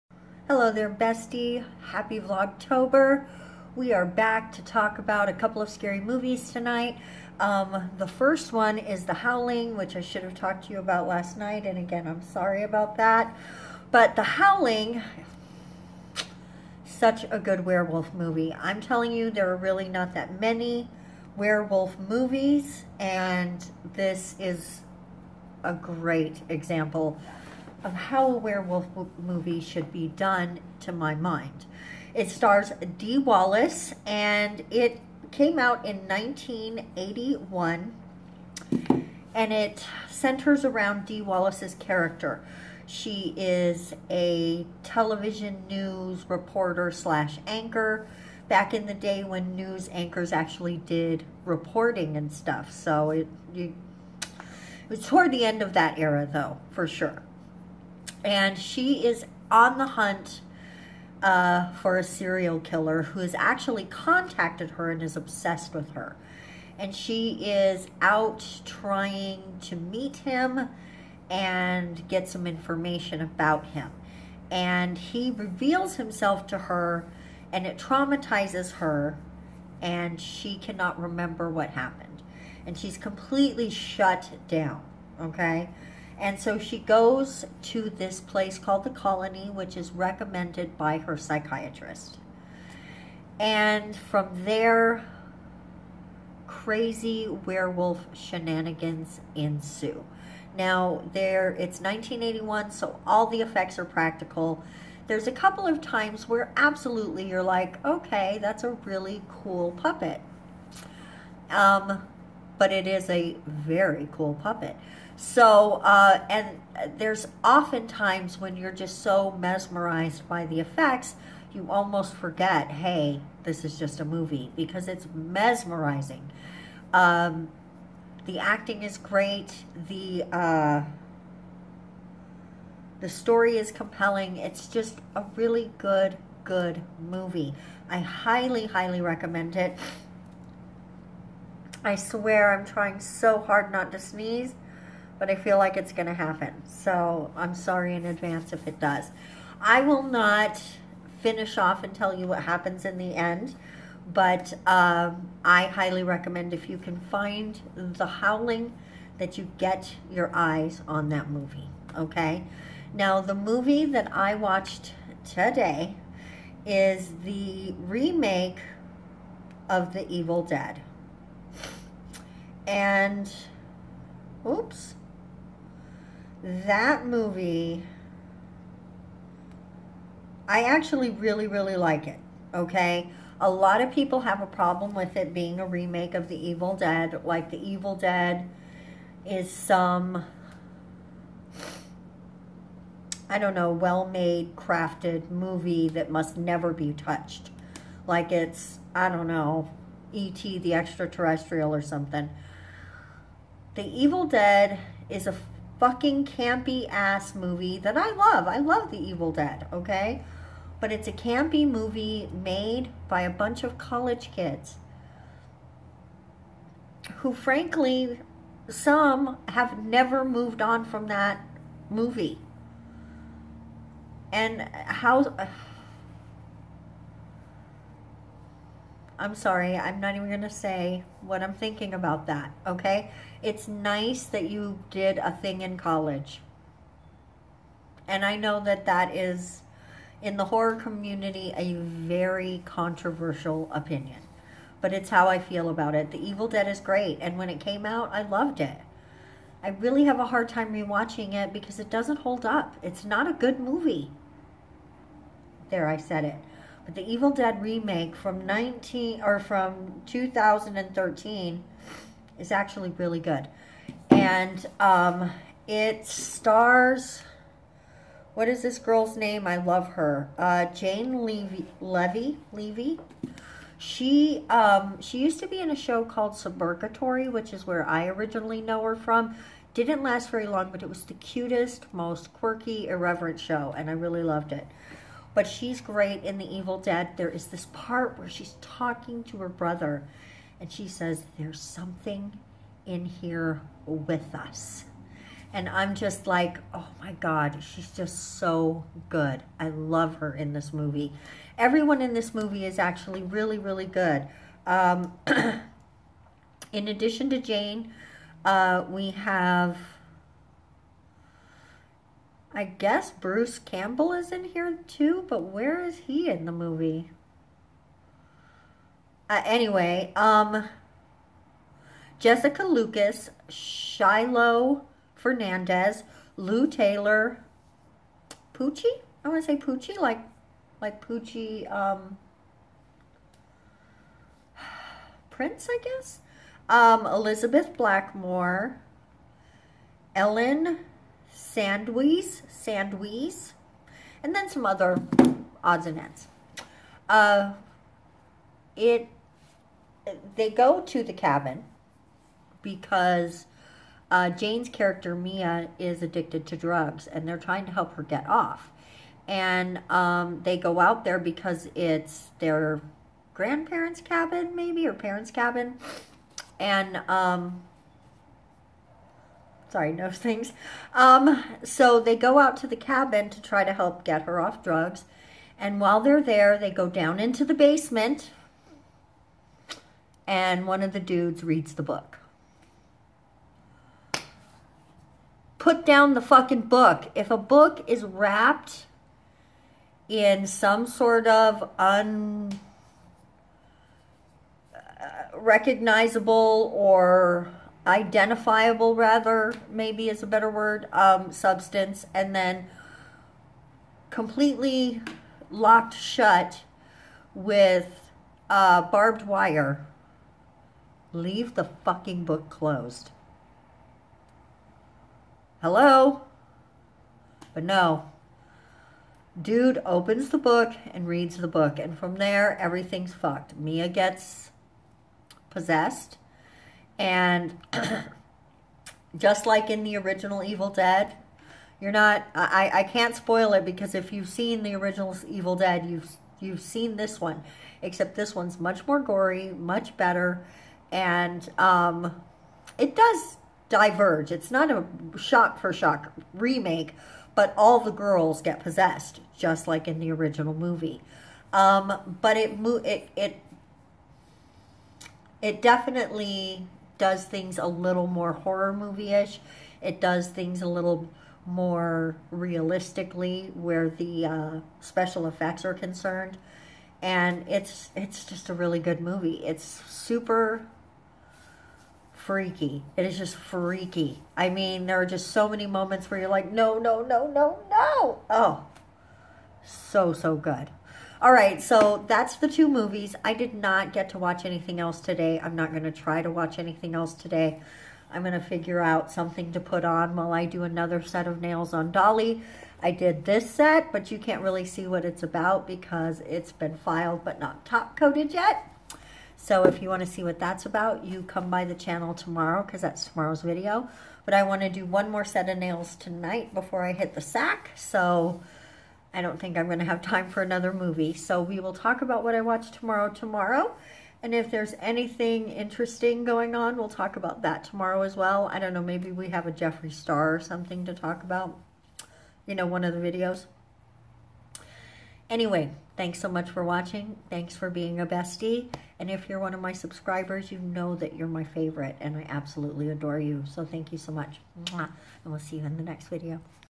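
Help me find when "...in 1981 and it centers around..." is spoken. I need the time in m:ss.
0:35.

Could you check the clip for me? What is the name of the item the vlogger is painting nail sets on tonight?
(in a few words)
Dolly.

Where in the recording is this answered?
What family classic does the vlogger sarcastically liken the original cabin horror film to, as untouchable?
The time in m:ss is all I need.
3:20.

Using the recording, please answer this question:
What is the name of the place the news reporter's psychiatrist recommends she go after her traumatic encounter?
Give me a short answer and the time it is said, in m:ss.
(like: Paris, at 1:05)
the Colony, at 1:28.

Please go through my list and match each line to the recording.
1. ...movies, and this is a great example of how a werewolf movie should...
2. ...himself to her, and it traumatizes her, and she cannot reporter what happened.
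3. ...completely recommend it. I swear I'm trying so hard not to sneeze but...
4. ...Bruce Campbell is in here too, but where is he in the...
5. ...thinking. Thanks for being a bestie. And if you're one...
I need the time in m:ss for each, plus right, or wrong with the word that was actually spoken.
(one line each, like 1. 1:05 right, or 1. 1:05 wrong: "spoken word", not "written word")
1. 0:21 right
2. 1:15 wrong: "remember", not "reporter"
3. 2:18 wrong: "highly", not "completely"
4. 5:13 right
5. 8:46 wrong: "watching", not "thinking".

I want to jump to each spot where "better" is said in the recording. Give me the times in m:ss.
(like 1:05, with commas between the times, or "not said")
6:40, 7:19.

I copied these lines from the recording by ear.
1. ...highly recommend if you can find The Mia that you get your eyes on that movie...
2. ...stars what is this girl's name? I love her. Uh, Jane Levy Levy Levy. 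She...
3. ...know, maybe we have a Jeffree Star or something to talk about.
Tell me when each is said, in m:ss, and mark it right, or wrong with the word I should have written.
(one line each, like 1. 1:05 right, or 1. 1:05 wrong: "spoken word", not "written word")
1. 2:35 wrong: "Howling", not "Mia"
2. 4:26 right
3. 8:38 right.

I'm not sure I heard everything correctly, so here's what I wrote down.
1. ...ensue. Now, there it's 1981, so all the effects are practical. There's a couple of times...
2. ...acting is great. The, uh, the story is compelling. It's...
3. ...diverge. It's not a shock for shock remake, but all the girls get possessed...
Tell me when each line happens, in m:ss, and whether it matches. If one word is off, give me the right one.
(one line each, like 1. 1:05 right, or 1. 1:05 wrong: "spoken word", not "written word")
1. 1:39 right
2. 2:08 right
3. 7:23 right.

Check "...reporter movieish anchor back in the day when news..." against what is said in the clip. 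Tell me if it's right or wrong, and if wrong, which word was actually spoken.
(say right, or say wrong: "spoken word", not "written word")
wrong: "slash", not "movieish".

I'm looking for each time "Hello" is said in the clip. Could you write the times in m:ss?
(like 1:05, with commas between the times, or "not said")
0:00, 6:55.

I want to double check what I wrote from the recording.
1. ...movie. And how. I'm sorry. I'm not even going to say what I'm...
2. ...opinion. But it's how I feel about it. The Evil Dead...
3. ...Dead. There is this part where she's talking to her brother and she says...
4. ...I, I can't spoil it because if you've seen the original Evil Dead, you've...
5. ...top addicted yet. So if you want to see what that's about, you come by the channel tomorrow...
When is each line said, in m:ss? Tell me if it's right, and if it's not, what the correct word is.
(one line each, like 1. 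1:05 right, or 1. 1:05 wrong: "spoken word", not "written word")
1. 3:41 right
2. 4:03 right
3. 4:46 right
4. 7:12 right
5. 8:17 wrong: "coated", not "addicted".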